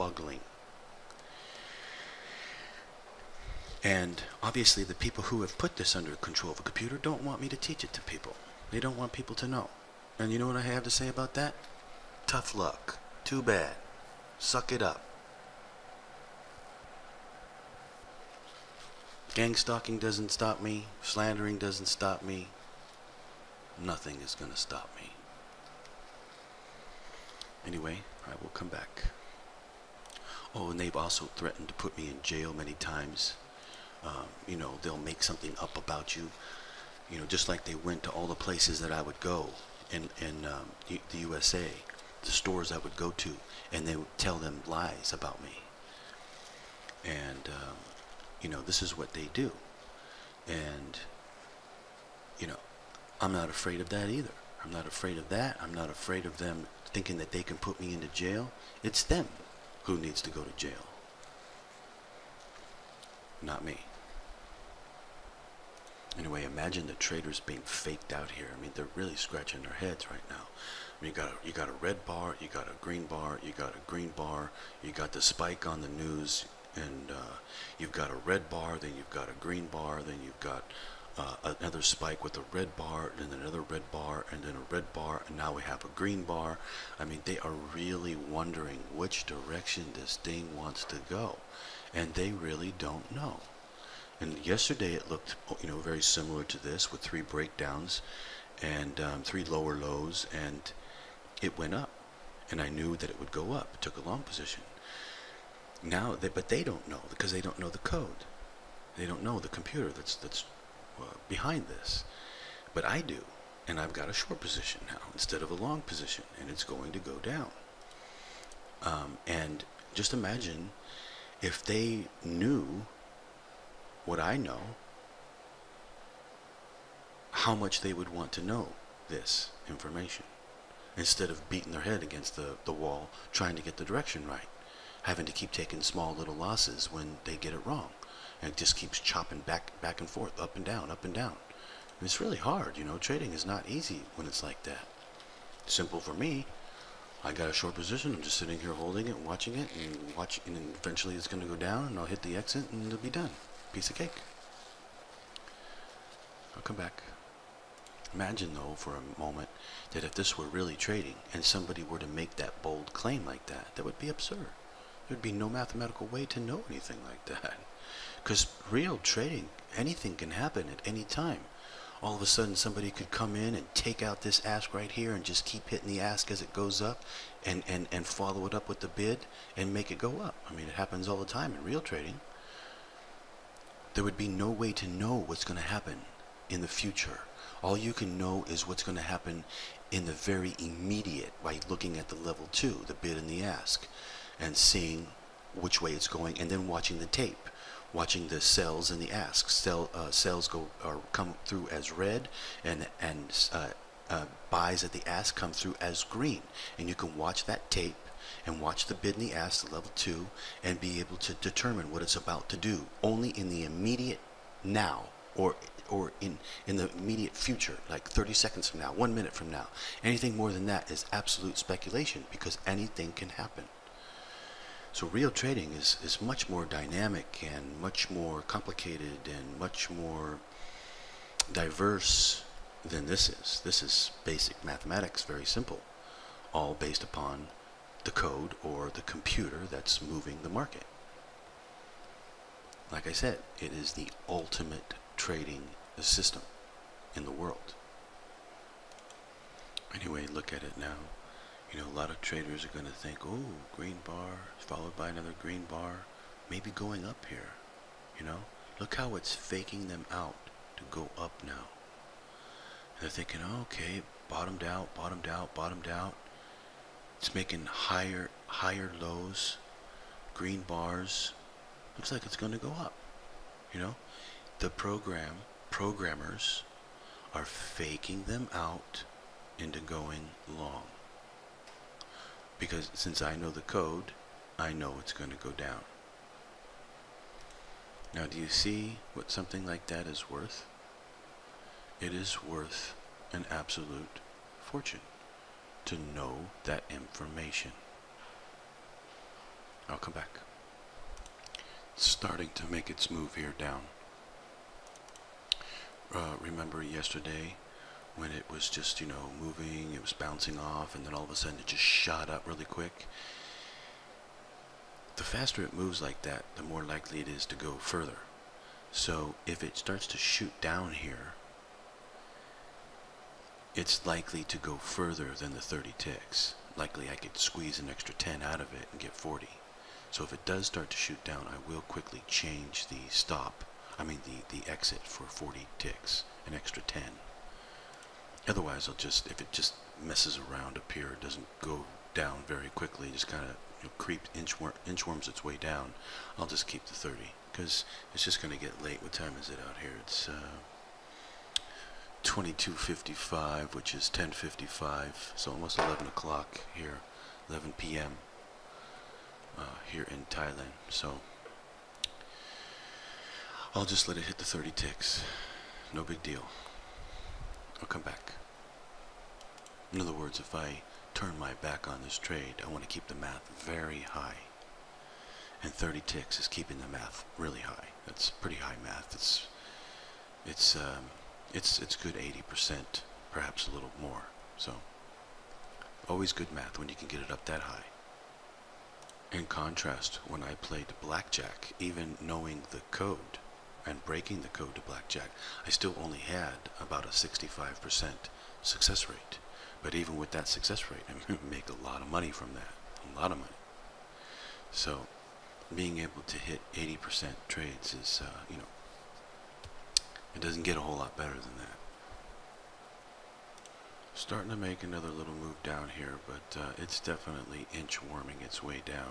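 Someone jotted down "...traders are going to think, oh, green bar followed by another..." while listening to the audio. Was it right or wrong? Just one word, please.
right.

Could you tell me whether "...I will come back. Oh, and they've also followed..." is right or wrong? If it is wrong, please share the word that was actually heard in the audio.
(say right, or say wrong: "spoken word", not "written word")
wrong: "threatened", not "followed".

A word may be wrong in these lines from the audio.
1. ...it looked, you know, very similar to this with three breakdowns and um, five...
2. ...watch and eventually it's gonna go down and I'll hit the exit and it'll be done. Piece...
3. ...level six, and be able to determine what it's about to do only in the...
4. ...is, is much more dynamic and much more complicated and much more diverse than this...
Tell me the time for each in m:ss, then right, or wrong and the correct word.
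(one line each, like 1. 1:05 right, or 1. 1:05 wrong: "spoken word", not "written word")
1. 1:34 wrong: "three", not "five"
2. 2:30 right
3. 3:29 wrong: "two", not "six"
4. 3:45 right.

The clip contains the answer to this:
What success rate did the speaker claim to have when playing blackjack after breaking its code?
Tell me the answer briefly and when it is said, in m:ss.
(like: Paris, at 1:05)
65%, at 6:37.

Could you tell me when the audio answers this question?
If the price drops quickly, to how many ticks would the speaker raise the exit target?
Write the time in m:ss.
5:28.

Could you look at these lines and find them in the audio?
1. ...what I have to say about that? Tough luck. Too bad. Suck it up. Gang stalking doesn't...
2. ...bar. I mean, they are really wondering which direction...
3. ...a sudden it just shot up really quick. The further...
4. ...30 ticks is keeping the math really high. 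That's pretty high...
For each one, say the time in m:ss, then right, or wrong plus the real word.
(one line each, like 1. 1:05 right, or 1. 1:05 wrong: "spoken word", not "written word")
1. 0:10 right
2. 1:26 right
3. 5:11 wrong: "faster", not "further"
4. 6:15 right.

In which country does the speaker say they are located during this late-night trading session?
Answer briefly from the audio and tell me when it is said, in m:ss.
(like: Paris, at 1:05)
Thailand, at 6:00.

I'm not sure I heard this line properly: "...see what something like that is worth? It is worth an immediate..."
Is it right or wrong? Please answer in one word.
wrong.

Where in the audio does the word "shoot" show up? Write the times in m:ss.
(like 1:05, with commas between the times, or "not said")
5:20, 5:30.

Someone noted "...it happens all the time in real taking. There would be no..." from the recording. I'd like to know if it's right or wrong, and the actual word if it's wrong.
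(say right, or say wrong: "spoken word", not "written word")
wrong: "trading", not "taking".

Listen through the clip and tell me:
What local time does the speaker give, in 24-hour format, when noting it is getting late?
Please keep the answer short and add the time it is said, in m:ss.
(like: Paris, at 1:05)
22:55, at 5:52.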